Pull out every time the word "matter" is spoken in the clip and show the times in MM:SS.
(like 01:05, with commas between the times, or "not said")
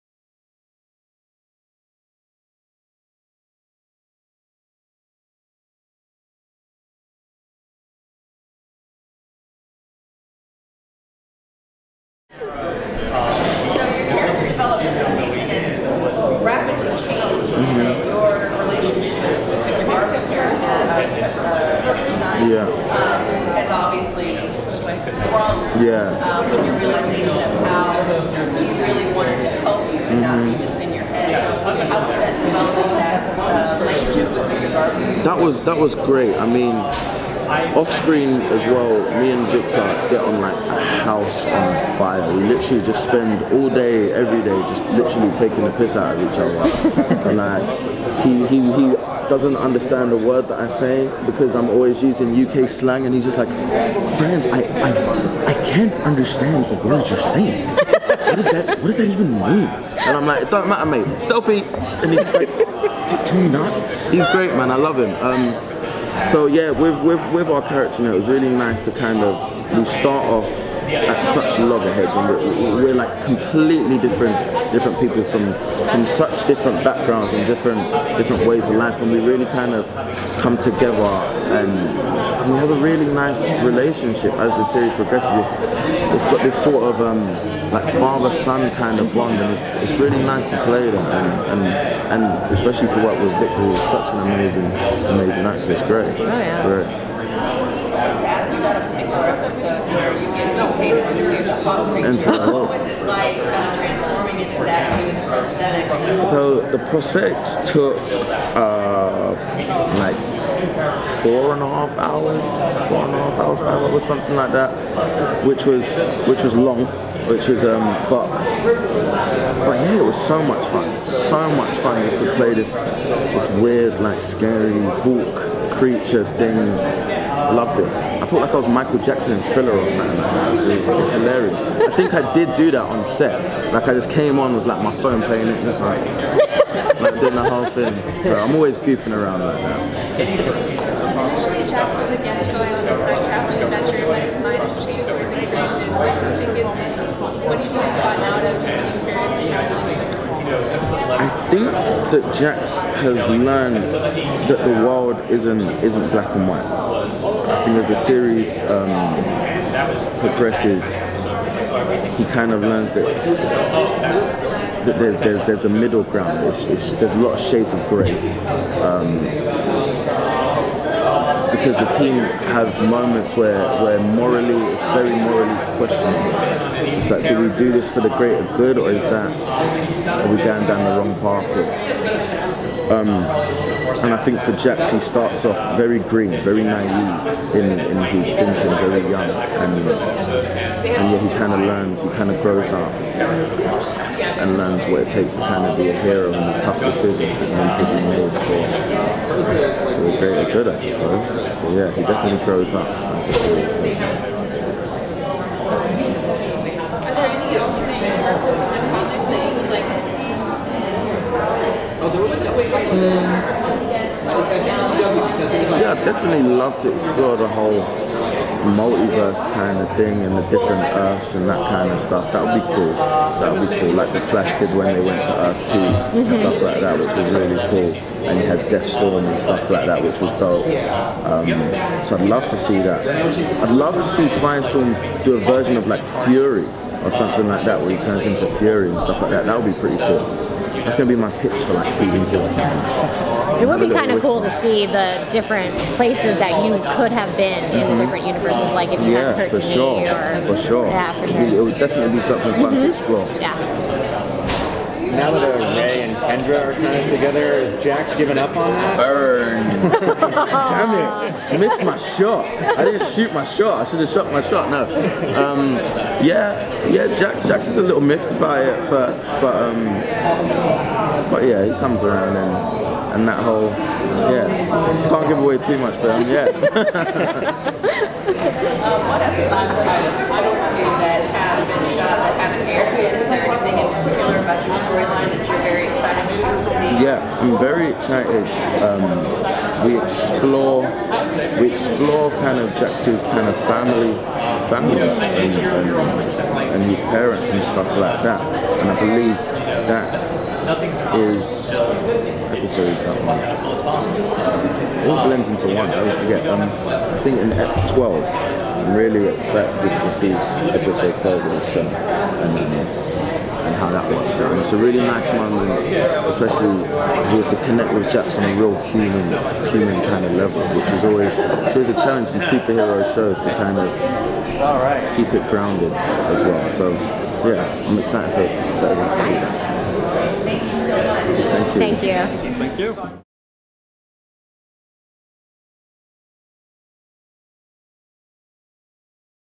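01:00.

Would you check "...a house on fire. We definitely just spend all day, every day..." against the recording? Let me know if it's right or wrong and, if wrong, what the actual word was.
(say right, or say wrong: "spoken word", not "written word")
wrong: "literally", not "definitely".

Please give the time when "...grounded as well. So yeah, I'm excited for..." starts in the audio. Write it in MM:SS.
05:25.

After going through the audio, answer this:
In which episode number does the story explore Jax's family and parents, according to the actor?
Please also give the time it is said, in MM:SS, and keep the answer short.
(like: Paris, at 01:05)
12, at 05:07.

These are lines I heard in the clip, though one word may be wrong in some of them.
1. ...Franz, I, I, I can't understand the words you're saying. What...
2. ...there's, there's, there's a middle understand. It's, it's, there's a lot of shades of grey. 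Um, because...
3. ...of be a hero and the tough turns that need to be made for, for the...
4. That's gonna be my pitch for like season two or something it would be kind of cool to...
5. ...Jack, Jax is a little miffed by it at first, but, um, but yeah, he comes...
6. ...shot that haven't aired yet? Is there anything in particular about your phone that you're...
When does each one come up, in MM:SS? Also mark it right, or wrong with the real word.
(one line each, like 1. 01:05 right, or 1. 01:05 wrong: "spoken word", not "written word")
1. 00:54 right
2. 02:44 wrong: "ground", not "understand"
3. 03:15 wrong: "decisions", not "turns"
4. 04:00 right
5. 04:27 right
6. 04:41 wrong: "storyline", not "phone".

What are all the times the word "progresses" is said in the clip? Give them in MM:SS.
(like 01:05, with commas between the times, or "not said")
01:24, 02:40.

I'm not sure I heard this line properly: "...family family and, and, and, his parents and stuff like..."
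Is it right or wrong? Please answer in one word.
right.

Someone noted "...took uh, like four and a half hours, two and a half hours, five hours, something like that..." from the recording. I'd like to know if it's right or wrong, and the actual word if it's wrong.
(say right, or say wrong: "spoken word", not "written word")
wrong: "four", not "two".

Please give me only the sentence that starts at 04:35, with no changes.
Can't give away too much, but um, yeah.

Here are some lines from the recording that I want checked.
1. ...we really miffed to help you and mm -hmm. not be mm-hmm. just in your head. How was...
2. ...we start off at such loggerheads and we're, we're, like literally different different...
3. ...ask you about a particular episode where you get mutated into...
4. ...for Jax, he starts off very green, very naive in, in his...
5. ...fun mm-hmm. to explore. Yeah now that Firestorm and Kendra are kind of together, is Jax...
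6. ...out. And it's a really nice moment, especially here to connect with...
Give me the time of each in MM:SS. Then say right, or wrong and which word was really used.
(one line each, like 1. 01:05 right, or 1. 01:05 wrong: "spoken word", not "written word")
1. 00:28 wrong: "wanted", not "miffed"
2. 01:09 wrong: "completely", not "literally"
3. 01:38 right
4. 03:04 right
5. 04:12 wrong: "Ray", not "Firestorm"
6. 05:14 right.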